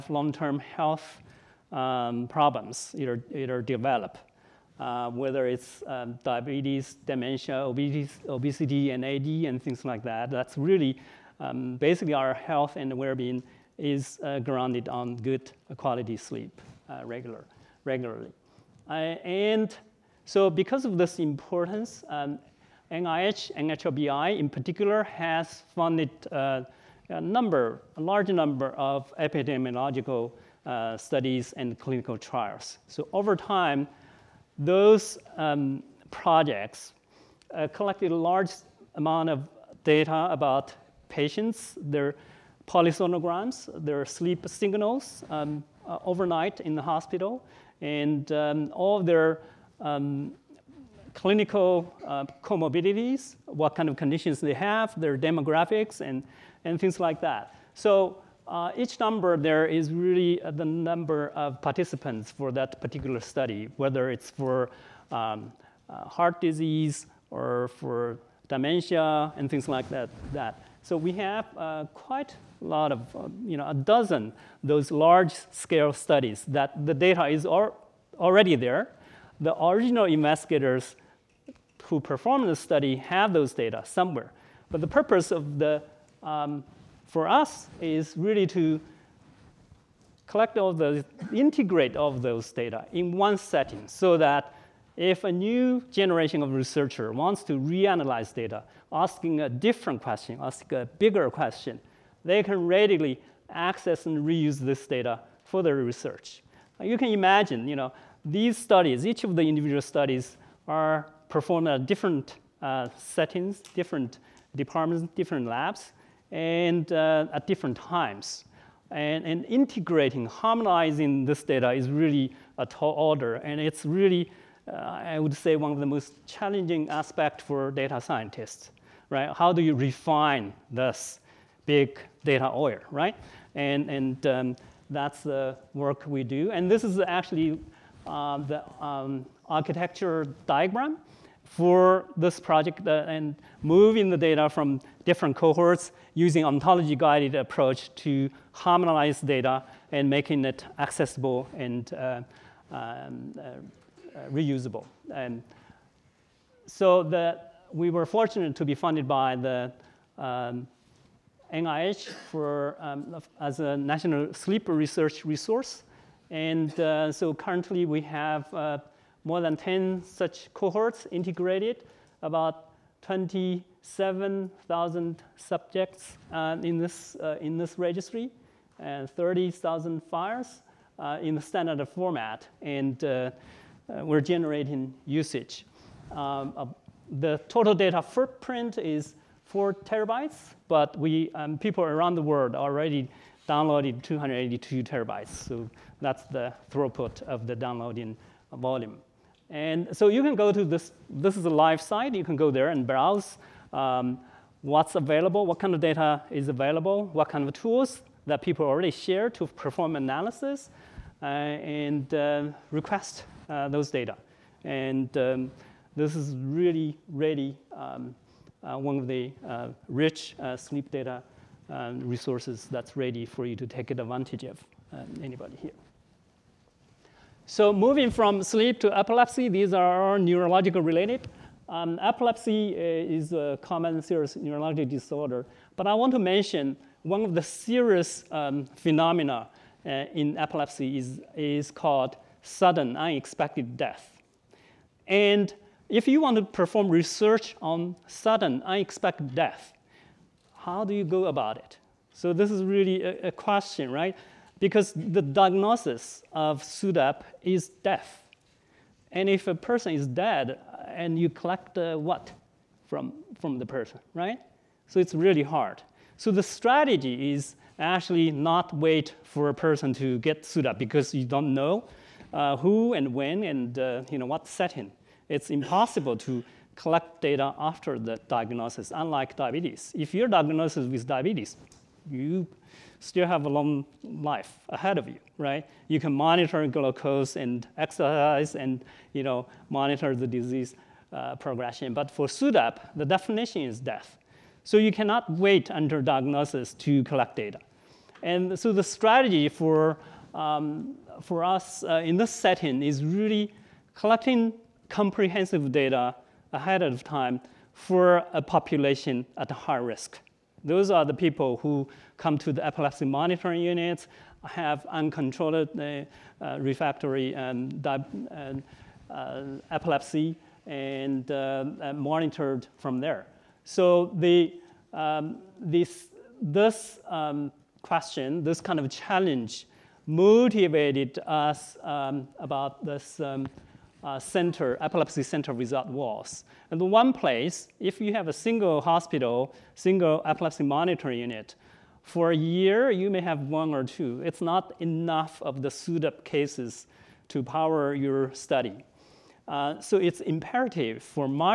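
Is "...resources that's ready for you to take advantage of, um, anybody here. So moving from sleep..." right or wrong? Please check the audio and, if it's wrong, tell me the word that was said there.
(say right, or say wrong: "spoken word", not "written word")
right.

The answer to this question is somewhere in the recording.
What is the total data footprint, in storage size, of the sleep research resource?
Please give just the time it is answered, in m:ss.
3:09.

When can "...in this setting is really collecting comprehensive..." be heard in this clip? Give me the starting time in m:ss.
5:02.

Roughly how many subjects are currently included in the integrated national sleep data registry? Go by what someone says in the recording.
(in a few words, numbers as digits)
27,000.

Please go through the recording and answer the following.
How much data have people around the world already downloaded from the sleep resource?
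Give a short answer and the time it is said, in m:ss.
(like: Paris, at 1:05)
282 terabytes, at 3:14.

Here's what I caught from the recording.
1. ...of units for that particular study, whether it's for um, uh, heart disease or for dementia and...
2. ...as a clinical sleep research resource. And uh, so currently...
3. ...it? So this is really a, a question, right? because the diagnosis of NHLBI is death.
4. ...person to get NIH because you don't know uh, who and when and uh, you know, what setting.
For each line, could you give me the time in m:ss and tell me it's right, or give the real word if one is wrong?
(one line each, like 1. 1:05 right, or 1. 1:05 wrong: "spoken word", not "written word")
1. 1:01 wrong: "participants", not "units"
2. 2:43 wrong: "national", not "clinical"
3. 4:11 wrong: "SUDEP", not "NHLBI"
4. 4:29 wrong: "SUDEP", not "NIH".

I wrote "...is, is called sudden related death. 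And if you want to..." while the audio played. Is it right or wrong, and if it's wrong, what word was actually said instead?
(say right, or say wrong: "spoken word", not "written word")
wrong: "unexpected", not "related".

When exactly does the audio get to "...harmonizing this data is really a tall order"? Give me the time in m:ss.
2:00.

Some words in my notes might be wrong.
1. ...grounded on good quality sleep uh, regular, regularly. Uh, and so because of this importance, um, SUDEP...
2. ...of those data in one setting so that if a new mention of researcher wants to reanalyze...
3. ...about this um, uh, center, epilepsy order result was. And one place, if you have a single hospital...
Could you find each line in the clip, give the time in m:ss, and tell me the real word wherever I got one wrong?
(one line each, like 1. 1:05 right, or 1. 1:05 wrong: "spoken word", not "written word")
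1. 0:14 wrong: "NIH", not "SUDEP"
2. 1:32 wrong: "generation", not "mention"
3. 5:32 wrong: "center", not "order".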